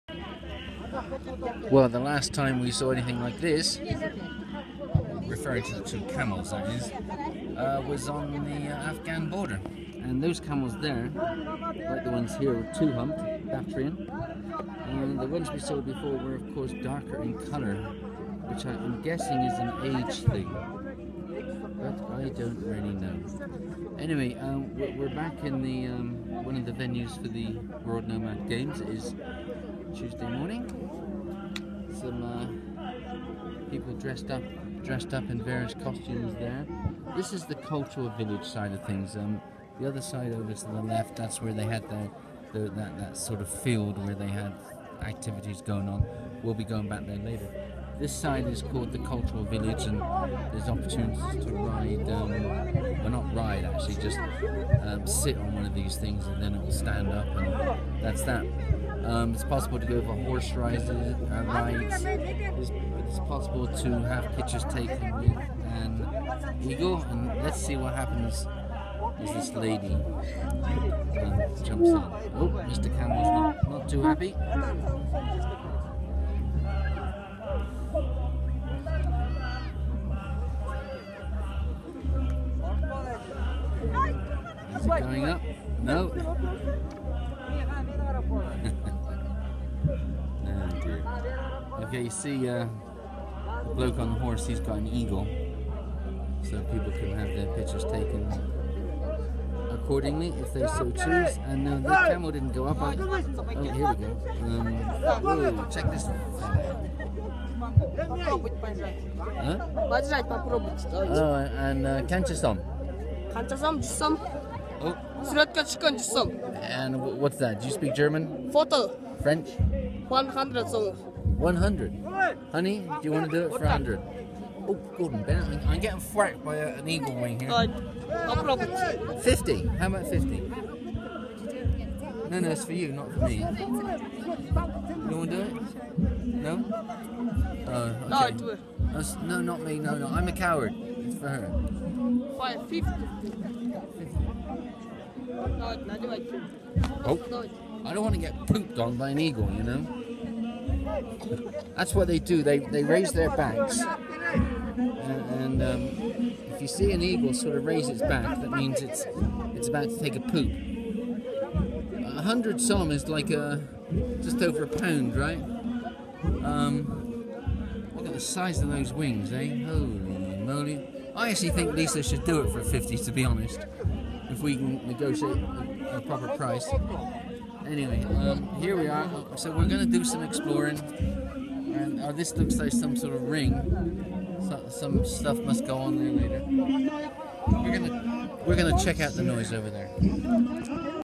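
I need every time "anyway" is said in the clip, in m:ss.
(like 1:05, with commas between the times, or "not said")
0:23, 2:57.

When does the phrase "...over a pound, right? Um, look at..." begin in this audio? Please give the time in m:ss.
2:44.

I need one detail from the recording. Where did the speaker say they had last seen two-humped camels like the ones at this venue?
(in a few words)
Afghan border.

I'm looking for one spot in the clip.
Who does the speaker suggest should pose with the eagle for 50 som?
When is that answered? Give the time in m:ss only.
2:51.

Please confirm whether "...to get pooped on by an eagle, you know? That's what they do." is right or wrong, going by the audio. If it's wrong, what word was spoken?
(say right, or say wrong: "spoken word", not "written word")
right.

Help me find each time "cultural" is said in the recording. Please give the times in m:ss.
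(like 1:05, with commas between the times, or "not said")
0:37, 0:48.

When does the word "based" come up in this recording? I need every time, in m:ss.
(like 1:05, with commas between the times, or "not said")
not said.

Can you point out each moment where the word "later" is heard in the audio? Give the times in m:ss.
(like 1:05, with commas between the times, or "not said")
0:47, 3:06.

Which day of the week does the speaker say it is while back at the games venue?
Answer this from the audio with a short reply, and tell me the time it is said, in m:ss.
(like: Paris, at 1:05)
Tuesday, at 0:30.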